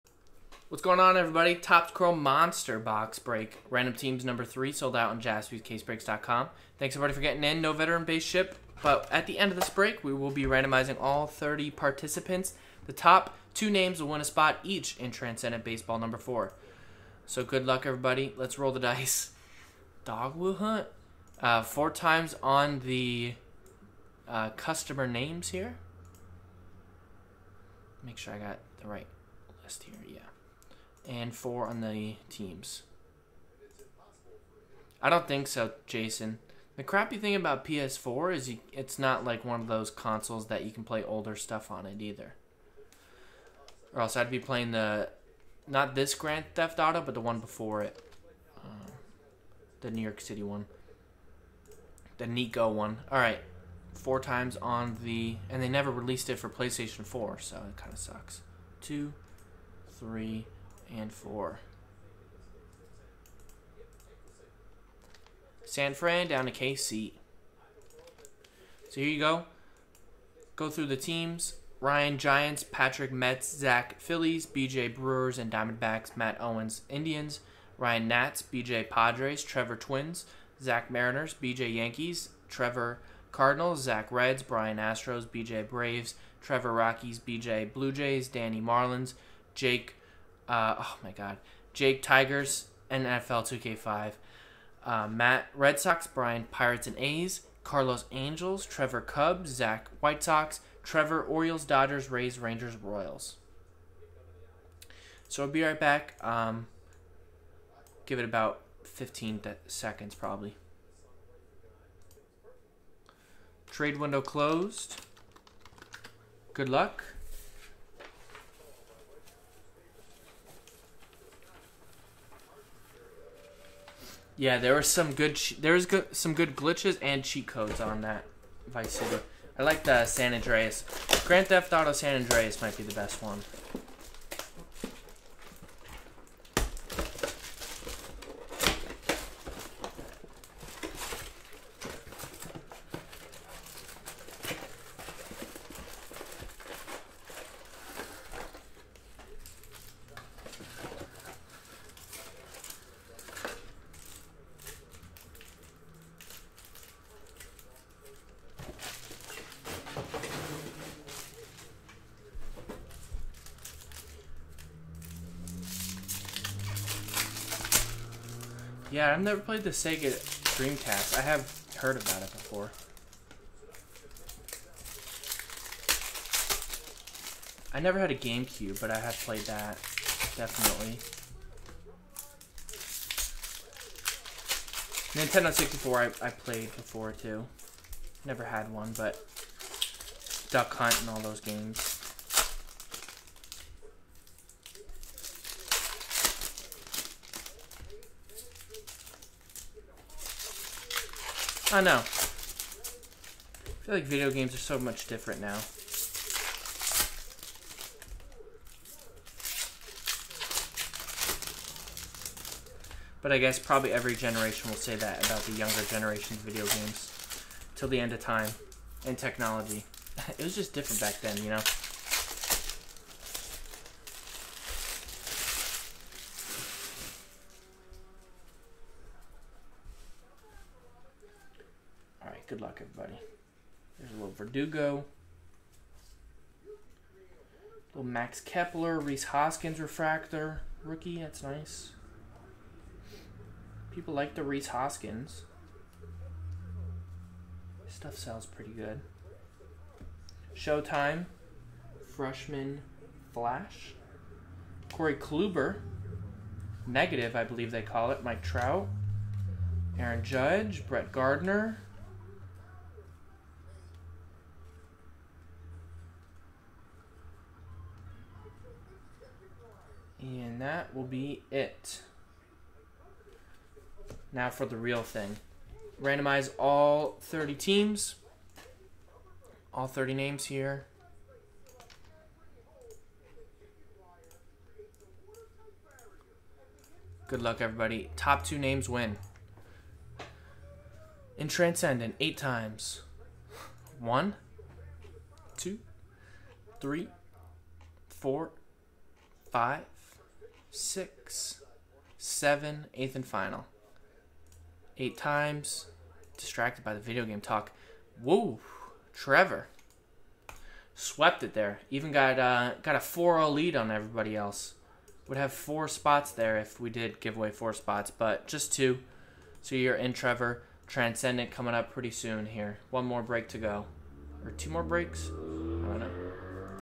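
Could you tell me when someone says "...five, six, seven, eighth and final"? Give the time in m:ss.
4:59.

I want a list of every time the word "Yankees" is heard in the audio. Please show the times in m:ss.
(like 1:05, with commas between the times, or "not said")
1:21.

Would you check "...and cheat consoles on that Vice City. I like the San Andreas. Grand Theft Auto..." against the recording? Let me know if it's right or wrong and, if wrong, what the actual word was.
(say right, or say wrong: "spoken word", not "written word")
wrong: "codes", not "consoles".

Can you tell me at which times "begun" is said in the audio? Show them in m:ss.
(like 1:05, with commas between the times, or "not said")
not said.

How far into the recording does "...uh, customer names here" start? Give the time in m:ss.
0:24.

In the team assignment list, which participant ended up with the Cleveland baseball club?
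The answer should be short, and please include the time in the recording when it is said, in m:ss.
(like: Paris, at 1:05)
Matt Owens, at 1:16.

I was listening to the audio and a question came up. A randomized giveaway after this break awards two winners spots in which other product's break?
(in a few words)
Transcendent Baseball number four.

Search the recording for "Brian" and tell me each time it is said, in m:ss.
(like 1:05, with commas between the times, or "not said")
1:24, 1:36.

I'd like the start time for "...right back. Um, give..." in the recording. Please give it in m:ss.
1:45.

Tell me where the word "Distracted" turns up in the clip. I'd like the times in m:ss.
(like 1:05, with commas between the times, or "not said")
5:06.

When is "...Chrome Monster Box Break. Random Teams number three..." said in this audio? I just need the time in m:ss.
0:01.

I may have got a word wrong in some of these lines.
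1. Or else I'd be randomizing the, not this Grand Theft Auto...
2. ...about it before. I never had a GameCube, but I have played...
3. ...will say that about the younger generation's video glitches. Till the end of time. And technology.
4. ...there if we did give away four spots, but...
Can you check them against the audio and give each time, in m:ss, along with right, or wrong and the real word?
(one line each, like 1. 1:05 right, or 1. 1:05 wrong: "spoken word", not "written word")
1. 0:43 wrong: "playing", not "randomizing"
2. 2:51 right
3. 3:34 wrong: "games", not "glitches"
4. 5:16 right.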